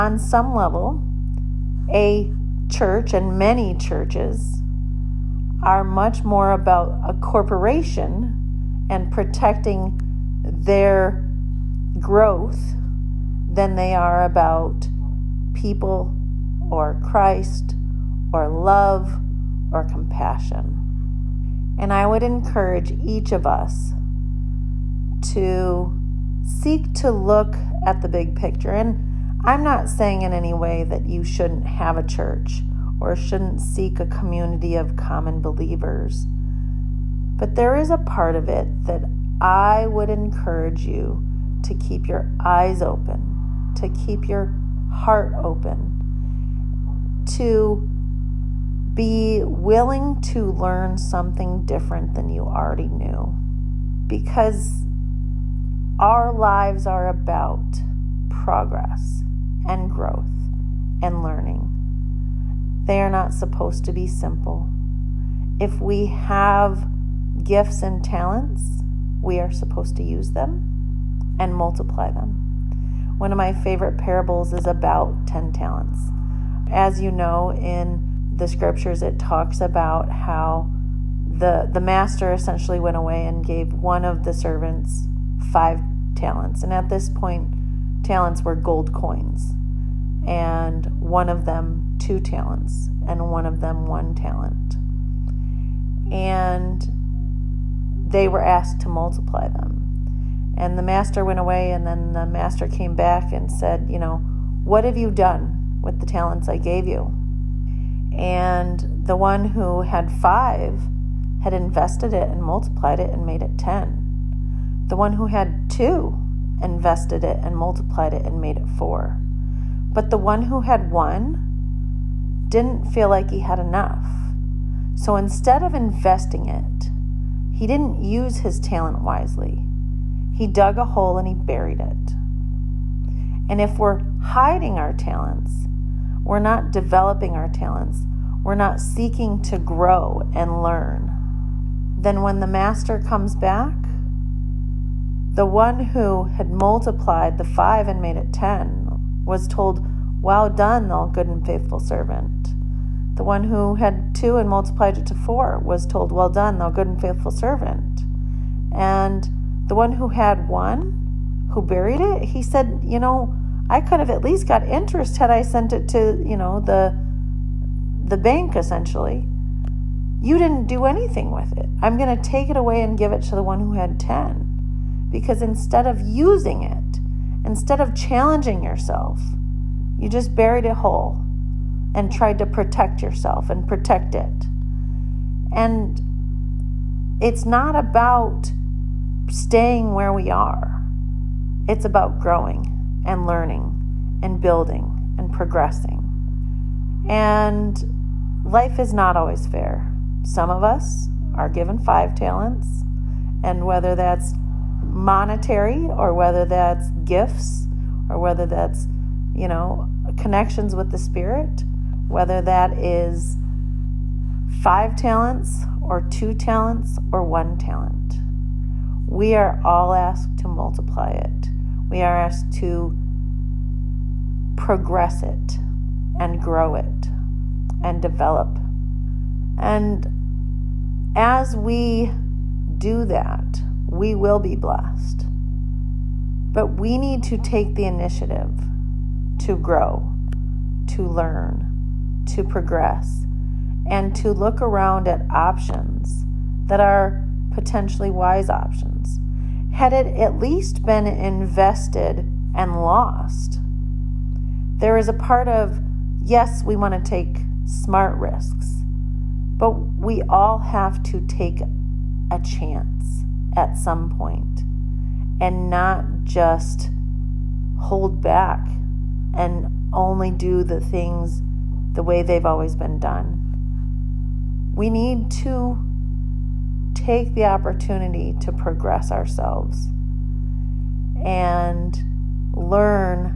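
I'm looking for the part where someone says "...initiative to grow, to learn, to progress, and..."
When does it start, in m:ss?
3:57.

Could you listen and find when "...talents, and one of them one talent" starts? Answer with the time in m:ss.
1:32.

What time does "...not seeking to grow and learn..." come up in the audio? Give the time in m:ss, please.
2:18.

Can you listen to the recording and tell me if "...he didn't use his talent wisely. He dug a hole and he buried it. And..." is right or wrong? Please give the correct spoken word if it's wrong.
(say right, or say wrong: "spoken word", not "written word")
right.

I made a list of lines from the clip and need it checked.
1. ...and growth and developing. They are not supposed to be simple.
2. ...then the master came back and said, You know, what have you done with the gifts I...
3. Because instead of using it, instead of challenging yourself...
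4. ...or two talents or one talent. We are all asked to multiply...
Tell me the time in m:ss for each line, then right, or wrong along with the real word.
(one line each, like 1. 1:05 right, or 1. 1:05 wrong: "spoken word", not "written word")
1. 0:59 wrong: "learning", not "developing"
2. 1:41 wrong: "talents", not "gifts"
3. 2:55 right
4. 3:35 right.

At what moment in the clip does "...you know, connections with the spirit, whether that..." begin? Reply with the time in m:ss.
3:29.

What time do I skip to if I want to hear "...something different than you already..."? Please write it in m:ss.
0:50.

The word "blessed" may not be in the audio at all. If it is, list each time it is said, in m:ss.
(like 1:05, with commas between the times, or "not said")
3:54.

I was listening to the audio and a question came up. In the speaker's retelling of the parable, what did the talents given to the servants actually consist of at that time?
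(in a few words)
gold coins.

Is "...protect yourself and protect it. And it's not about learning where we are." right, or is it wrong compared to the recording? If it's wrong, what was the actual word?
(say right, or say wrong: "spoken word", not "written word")
wrong: "staying", not "learning".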